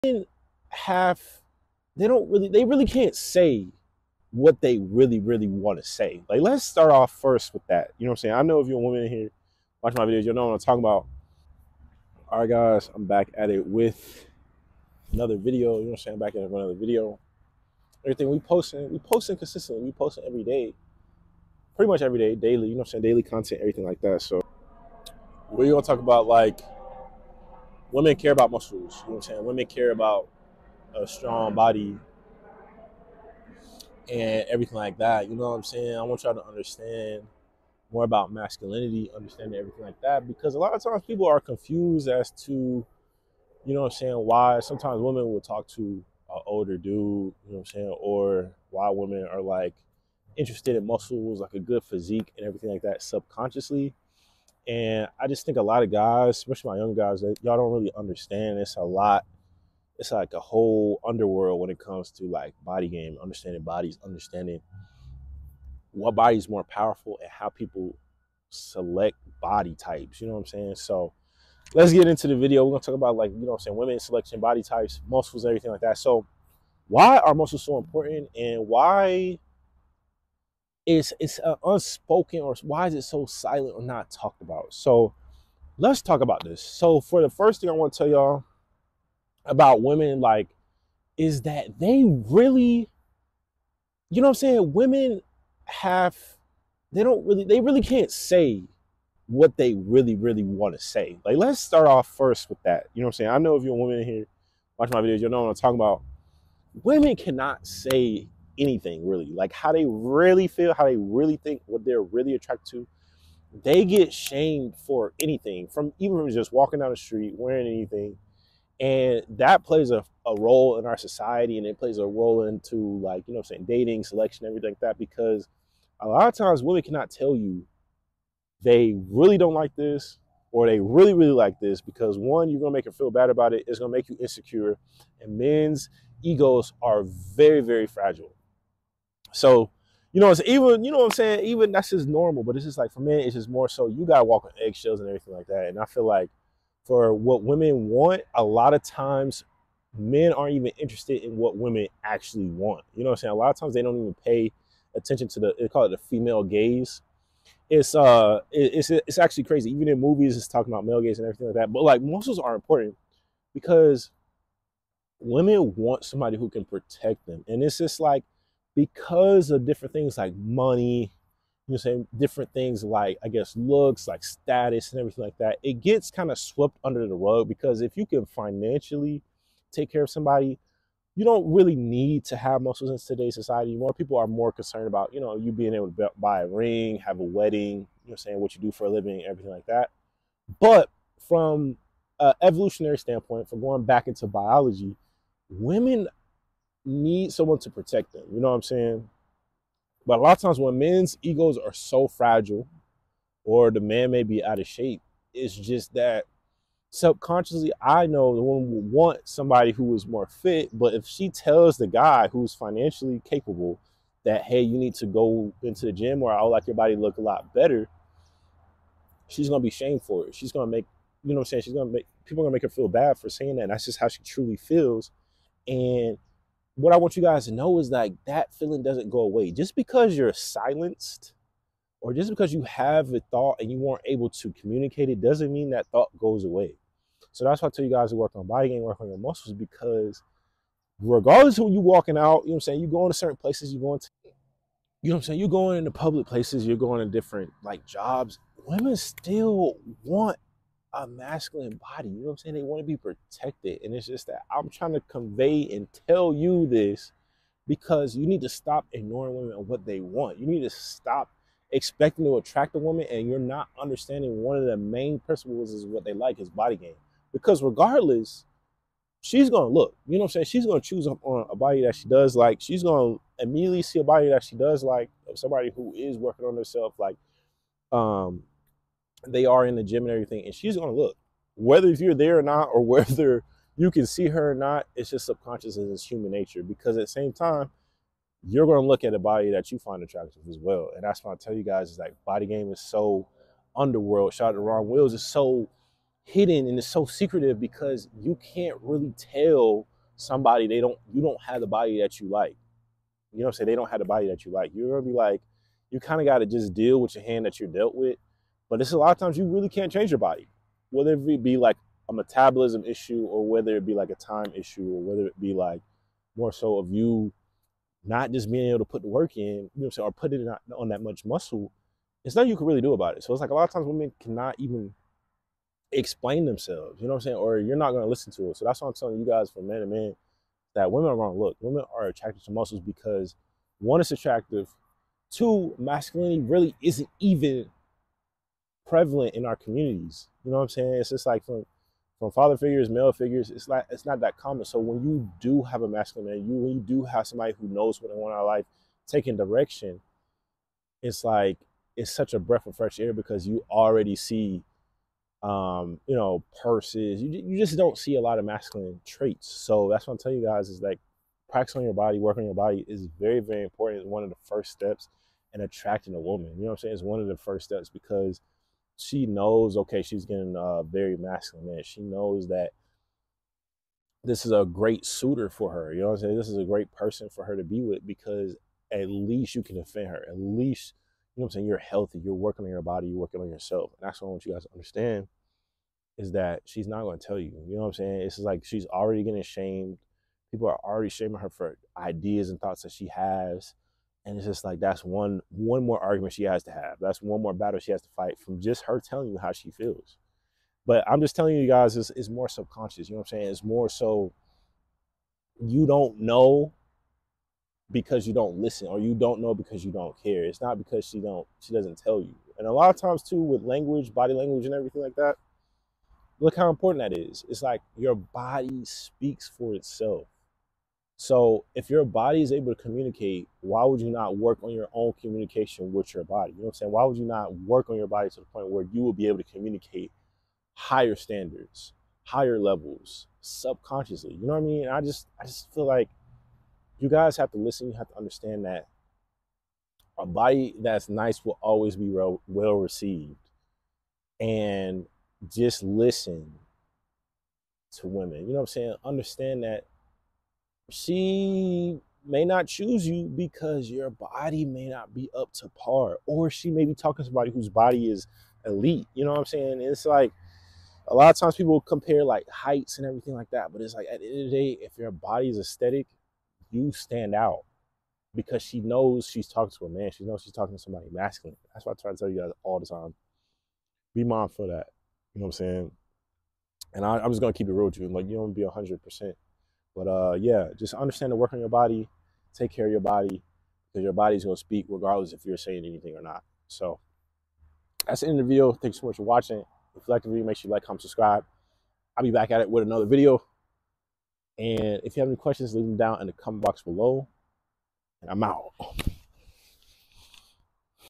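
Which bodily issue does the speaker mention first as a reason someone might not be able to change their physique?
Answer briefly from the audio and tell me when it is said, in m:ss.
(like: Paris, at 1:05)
metabolism, at 5:12.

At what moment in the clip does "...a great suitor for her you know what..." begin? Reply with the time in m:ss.
6:14.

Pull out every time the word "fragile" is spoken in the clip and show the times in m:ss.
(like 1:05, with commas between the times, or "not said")
2:17, 3:22.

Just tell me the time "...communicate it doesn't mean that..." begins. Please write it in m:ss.
3:54.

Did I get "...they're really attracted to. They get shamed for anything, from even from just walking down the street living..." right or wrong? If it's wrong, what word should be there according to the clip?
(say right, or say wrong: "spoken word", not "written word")
wrong: "wearing", not "living".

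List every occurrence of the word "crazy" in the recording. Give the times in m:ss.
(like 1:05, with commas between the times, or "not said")
2:39.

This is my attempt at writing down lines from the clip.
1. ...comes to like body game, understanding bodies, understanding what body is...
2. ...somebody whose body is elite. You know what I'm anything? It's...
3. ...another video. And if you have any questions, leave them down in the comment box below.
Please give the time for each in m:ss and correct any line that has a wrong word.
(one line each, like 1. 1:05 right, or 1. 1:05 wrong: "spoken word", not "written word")
1. 1:01 right
2. 7:37 wrong: "saying", not "anything"
3. 8:12 right.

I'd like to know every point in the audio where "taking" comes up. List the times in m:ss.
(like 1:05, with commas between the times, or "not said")
5:49.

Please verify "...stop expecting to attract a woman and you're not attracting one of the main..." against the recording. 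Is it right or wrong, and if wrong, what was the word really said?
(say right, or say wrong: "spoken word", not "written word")
wrong: "understanding", not "attracting".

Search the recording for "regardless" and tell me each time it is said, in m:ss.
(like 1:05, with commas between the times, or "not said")
4:00, 4:27, 8:04.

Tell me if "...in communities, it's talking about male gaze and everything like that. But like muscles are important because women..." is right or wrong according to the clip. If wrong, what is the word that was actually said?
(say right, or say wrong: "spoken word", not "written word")
wrong: "movies", not "communities".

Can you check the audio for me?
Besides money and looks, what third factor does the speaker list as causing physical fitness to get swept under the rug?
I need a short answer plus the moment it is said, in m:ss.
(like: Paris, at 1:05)
status, at 2:54.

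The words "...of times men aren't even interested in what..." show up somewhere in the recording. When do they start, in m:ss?
2:28.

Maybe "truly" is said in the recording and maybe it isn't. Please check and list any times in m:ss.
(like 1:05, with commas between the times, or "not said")
3:44.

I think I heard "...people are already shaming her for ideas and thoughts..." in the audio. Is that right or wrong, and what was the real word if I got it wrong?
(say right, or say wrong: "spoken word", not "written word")
right.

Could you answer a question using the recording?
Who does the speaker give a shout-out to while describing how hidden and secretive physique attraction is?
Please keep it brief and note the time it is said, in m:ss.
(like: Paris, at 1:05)
Rom Wills, at 4:54.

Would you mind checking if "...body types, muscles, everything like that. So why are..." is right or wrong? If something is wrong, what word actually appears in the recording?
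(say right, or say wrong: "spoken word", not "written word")
right.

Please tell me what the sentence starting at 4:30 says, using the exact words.
She's gonna choose on a body that she does like.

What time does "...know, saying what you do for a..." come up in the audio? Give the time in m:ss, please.
3:08.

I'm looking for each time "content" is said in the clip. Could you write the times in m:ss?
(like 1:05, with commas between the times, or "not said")
0:23.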